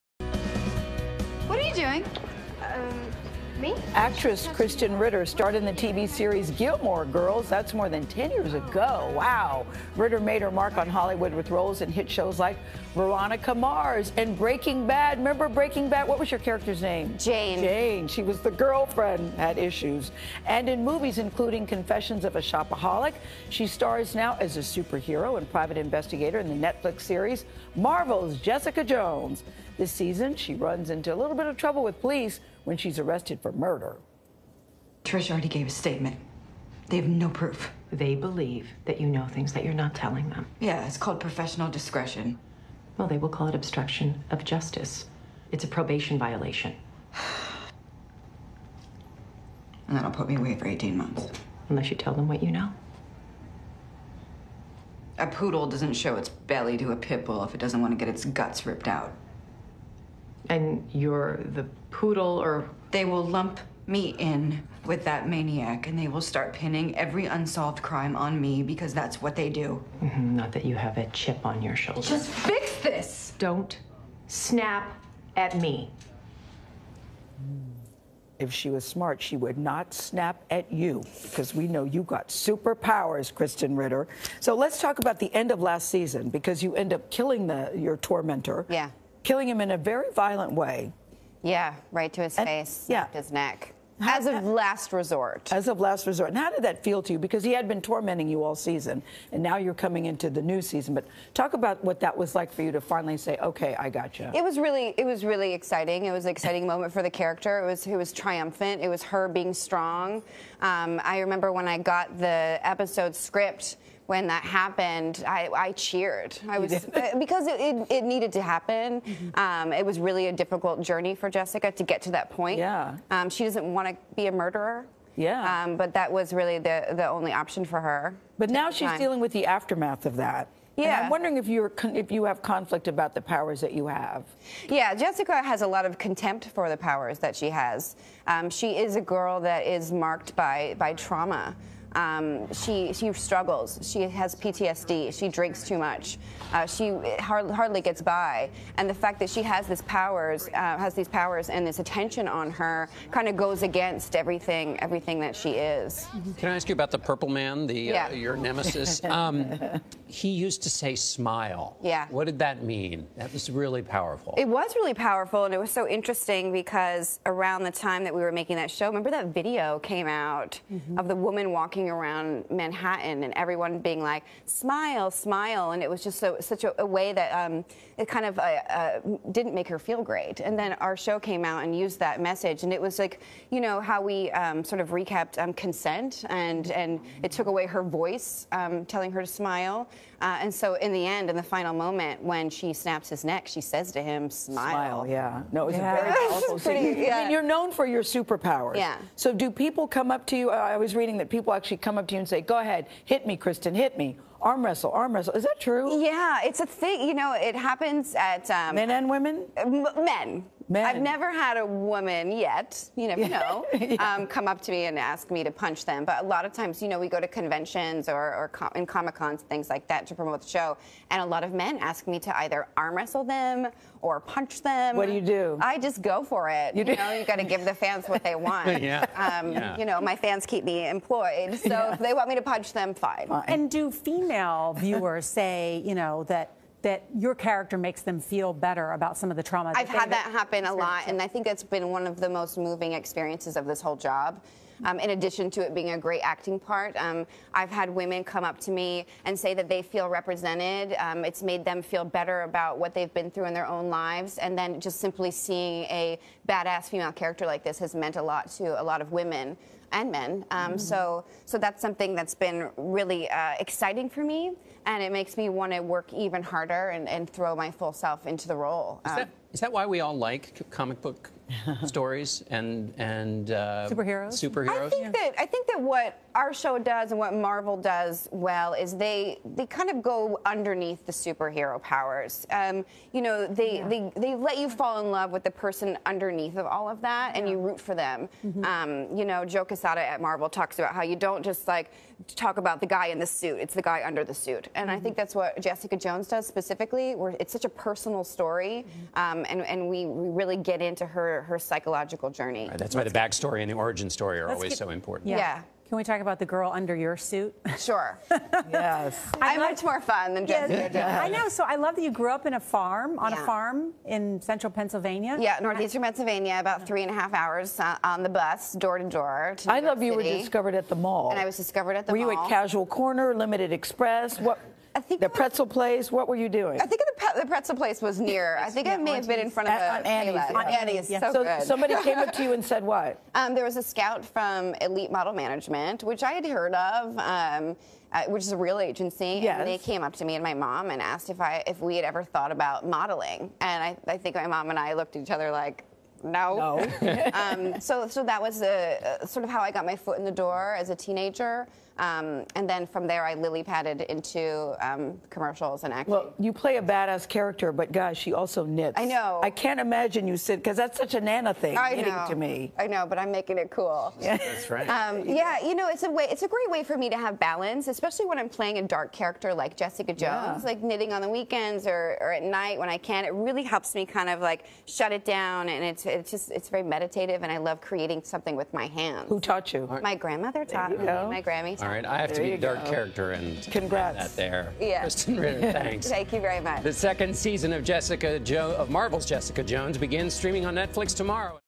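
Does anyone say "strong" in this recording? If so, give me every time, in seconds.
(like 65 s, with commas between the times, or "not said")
109 s.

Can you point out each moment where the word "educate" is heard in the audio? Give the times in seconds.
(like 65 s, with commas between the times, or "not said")
not said.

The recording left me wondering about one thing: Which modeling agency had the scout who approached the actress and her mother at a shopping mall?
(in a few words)
Elite Model Management.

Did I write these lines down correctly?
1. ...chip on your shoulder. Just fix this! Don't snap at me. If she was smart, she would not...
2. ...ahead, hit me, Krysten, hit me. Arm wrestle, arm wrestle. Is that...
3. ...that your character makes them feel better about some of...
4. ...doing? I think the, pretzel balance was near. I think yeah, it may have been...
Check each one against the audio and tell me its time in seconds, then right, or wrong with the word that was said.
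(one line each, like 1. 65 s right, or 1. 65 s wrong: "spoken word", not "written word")
1. 71 s right
2. 202 s right
3. 236 s right
4. 326 s wrong: "place", not "balance".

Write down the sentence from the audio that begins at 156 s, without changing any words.
Can I ask you about the Purple Man, the uh, yeah.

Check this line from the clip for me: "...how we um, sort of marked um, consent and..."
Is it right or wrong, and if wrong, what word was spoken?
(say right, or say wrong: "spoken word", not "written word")
wrong: "recapped", not "marked".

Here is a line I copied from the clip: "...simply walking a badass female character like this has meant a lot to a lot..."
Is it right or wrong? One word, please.
wrong.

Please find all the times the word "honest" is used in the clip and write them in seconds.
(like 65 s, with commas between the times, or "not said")
not said.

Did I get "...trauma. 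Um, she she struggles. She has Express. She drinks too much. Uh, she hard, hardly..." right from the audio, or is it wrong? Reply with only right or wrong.
wrong.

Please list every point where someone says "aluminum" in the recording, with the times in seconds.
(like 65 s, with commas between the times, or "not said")
not said.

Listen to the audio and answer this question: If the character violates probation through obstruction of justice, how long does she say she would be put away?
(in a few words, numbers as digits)
18 months.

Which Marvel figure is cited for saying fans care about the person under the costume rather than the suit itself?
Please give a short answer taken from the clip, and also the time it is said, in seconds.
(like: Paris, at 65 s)
Joe Quesada, at 289 s.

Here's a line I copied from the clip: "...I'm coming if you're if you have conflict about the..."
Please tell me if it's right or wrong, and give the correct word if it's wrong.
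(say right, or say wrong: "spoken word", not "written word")
wrong: "wondering", not "coming".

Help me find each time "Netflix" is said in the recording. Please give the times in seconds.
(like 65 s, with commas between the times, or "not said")
26 s, 390 s.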